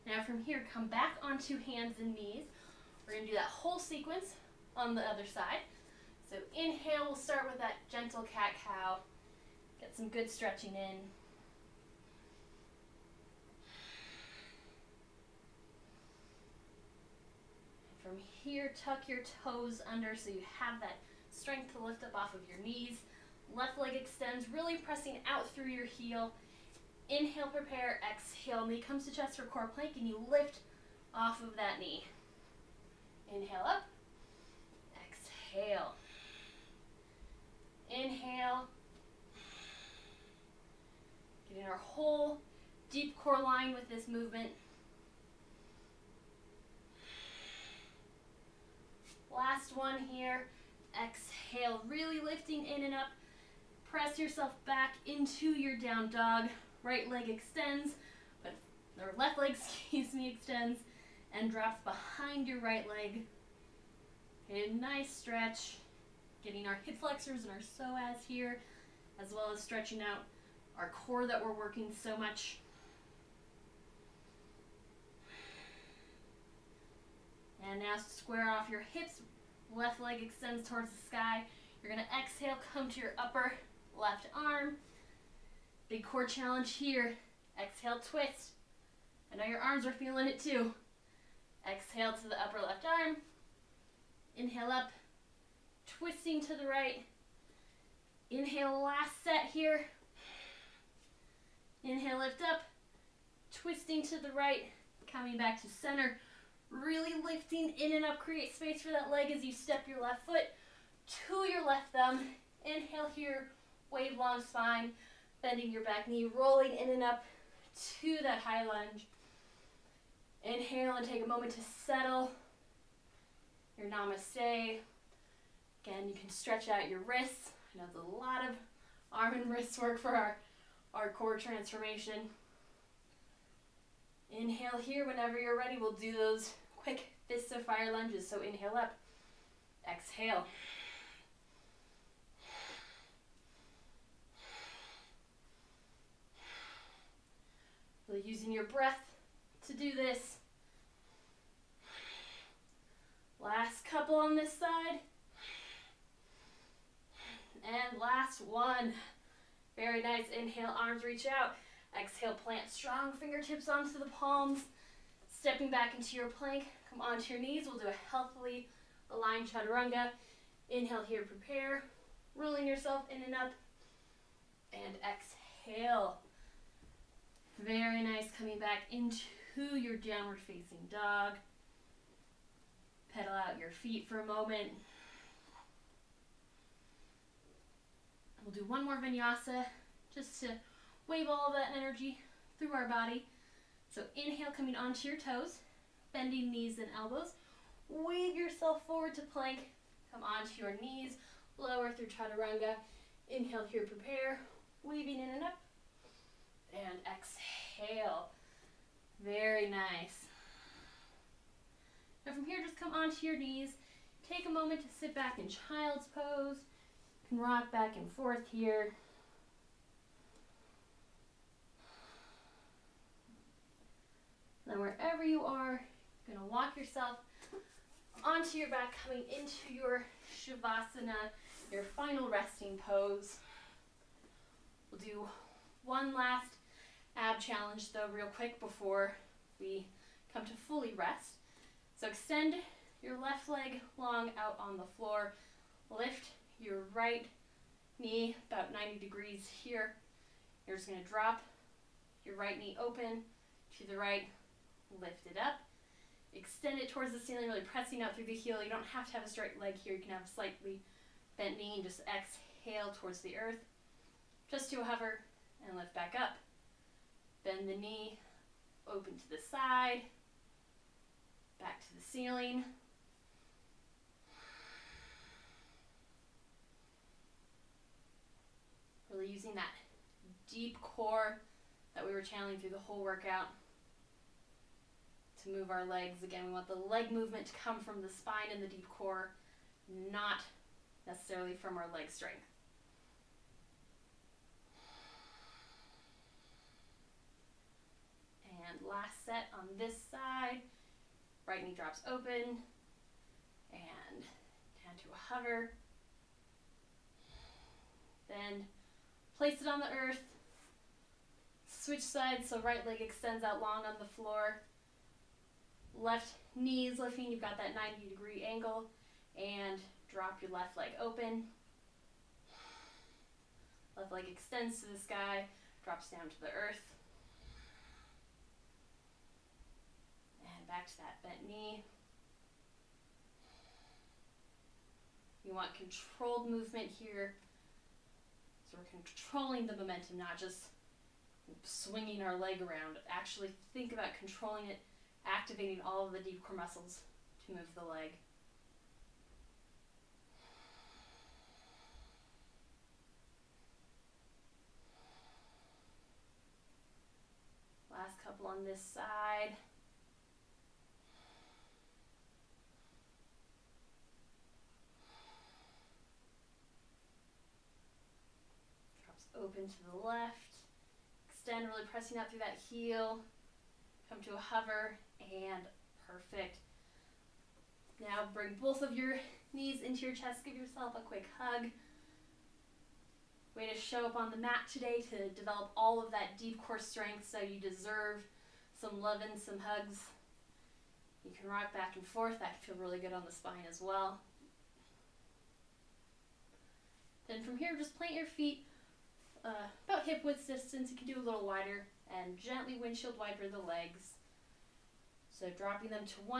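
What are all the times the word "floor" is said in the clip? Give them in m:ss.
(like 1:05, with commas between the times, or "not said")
4:04, 5:14.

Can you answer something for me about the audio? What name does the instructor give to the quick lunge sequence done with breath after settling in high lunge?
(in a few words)
fists of fire lunges.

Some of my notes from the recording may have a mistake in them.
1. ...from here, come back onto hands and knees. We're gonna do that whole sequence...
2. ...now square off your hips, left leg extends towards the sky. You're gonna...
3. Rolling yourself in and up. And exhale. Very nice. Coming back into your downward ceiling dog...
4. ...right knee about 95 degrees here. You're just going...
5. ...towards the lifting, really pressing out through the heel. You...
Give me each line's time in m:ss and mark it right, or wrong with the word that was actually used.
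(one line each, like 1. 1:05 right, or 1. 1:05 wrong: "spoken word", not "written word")
1. 0:00 right
2. 1:17 right
3. 2:52 wrong: "facing", not "ceiling"
4. 4:06 wrong: "90", not "95"
5. 4:16 wrong: "ceiling", not "lifting".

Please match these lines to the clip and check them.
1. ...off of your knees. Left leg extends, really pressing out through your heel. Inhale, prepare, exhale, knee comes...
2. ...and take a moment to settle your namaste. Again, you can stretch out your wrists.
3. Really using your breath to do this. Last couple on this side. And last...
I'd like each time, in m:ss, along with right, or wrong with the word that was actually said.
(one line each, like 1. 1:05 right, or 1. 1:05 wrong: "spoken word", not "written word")
1. 0:22 right
2. 2:00 right
3. 2:28 right.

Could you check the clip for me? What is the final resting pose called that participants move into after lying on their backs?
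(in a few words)
Shavasana.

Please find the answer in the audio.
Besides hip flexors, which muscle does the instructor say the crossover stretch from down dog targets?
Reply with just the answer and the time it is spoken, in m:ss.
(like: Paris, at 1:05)
psoas, at 1:07.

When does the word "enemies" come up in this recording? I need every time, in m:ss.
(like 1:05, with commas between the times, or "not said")
not said.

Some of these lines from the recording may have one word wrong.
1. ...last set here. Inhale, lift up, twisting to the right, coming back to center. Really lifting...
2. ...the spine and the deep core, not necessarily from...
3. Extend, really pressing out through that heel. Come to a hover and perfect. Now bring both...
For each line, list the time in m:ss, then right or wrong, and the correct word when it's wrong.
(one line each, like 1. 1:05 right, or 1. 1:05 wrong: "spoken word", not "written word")
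1. 1:38 right
2. 4:48 right
3. 6:11 right.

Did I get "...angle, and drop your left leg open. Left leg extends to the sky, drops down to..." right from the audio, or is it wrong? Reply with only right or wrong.
right.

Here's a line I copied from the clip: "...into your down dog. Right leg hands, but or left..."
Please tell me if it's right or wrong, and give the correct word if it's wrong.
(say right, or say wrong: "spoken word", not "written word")
wrong: "extends", not "hands".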